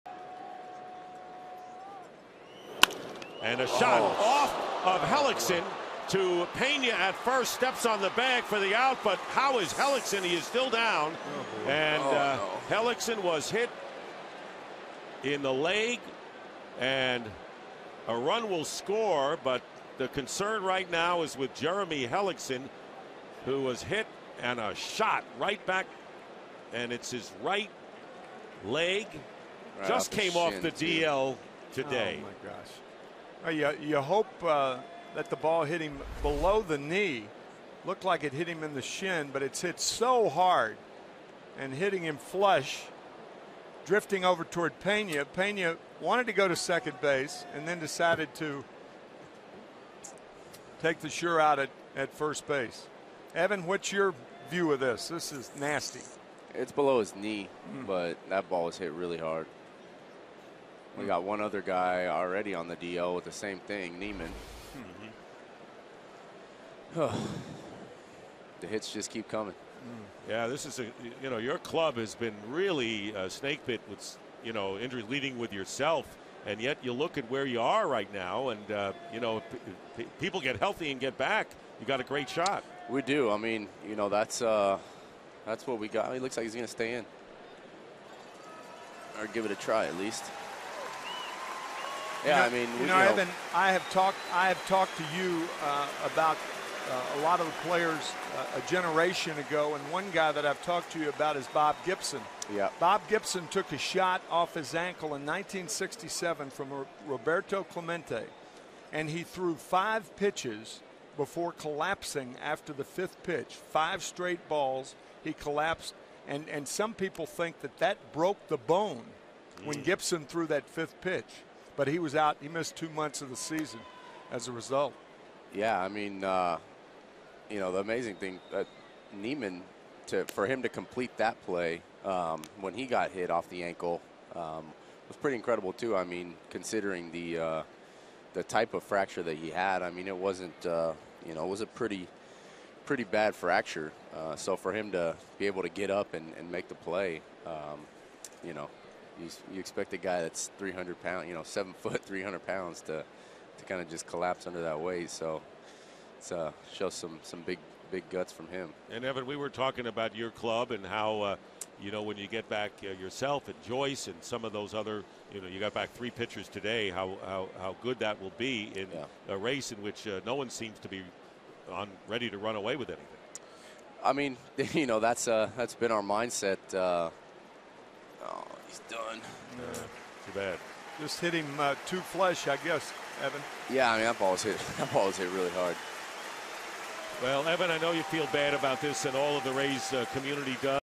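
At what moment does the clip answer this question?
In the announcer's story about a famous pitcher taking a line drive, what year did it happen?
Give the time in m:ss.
1:45.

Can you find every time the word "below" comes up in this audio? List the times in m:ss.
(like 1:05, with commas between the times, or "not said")
0:36, 0:56.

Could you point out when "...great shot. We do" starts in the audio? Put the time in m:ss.
1:22.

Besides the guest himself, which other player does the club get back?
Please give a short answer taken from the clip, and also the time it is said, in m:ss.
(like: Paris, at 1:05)
Joyce, at 2:43.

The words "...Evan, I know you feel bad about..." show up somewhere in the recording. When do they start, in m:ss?
3:07.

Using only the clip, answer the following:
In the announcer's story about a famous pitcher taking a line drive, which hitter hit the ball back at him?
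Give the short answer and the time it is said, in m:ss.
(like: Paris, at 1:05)
Roberto Clemente, at 1:47.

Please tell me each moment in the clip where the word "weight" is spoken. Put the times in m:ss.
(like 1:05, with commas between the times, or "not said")
2:34.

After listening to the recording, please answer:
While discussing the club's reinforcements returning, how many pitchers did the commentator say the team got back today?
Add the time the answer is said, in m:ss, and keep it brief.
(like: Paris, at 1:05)
3, at 2:45.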